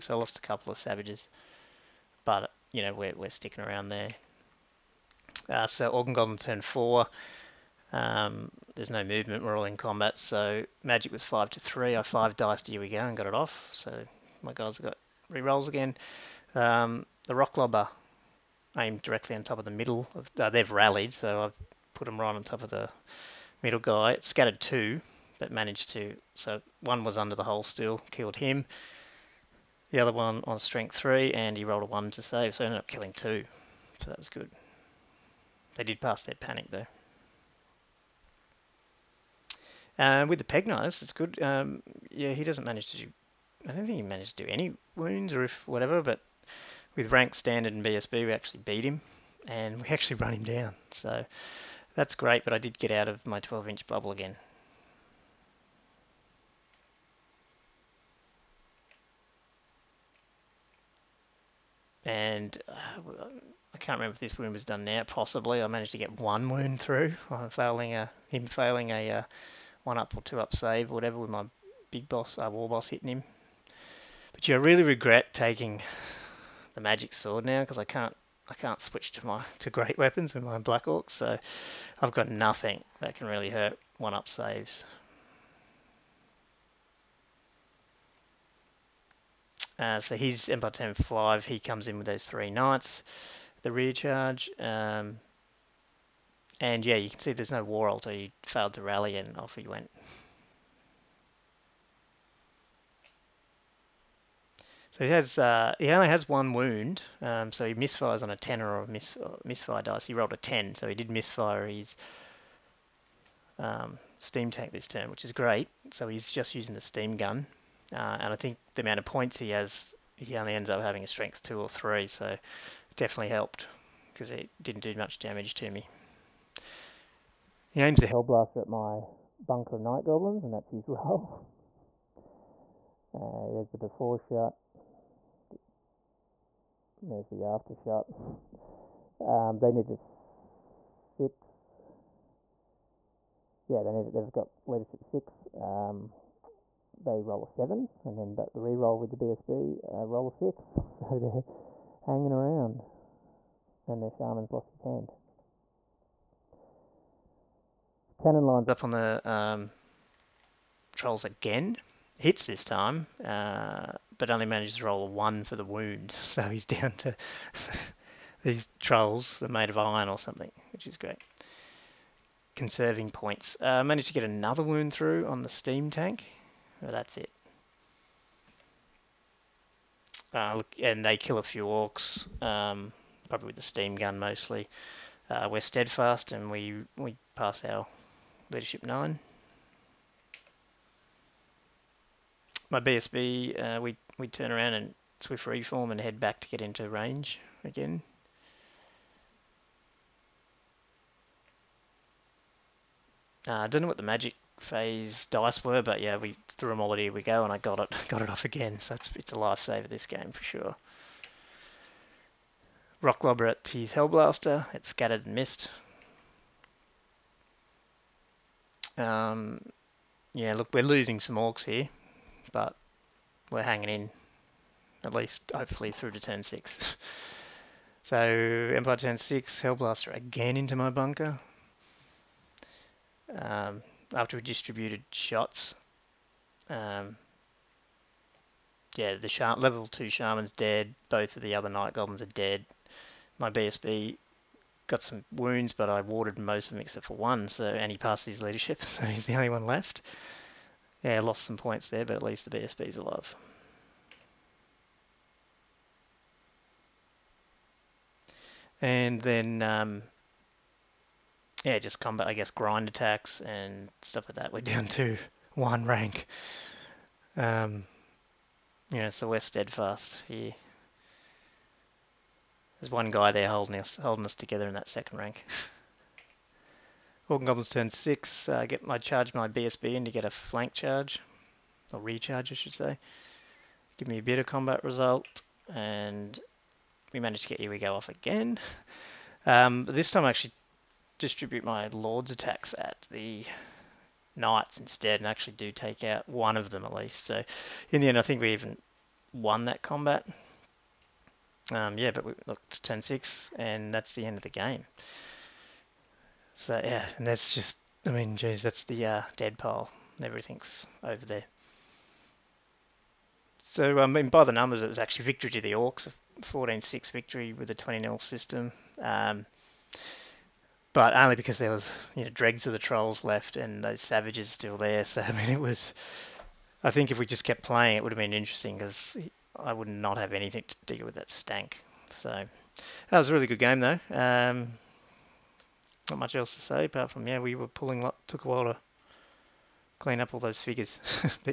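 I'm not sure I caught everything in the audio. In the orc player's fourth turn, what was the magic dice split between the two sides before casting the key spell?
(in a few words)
5 to 3.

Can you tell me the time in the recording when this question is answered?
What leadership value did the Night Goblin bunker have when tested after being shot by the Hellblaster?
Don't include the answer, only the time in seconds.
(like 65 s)
144 s.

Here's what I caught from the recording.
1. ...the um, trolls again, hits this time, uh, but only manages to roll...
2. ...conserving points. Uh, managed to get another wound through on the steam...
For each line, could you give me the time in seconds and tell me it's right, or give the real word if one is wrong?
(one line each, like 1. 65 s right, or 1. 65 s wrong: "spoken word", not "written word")
1. 158 s right
2. 172 s right.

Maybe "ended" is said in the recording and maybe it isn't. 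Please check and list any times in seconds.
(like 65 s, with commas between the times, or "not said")
32 s.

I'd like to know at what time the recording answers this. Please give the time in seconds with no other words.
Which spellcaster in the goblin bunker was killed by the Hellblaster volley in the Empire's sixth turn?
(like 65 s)
239 s.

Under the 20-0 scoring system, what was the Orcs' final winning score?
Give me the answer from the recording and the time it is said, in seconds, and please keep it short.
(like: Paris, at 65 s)
14-6, at 316 s.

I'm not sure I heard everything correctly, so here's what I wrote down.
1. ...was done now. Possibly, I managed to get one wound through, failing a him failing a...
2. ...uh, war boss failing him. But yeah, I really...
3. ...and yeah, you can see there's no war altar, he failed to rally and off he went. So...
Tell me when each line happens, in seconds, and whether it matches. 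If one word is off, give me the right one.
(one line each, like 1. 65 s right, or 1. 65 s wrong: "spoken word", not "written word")
1. 64 s right
2. 72 s wrong: "hitting", not "failing"
3. 96 s right.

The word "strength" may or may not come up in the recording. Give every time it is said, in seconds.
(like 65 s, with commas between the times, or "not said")
30 s, 121 s.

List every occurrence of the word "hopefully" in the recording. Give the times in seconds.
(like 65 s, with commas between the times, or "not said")
225 s.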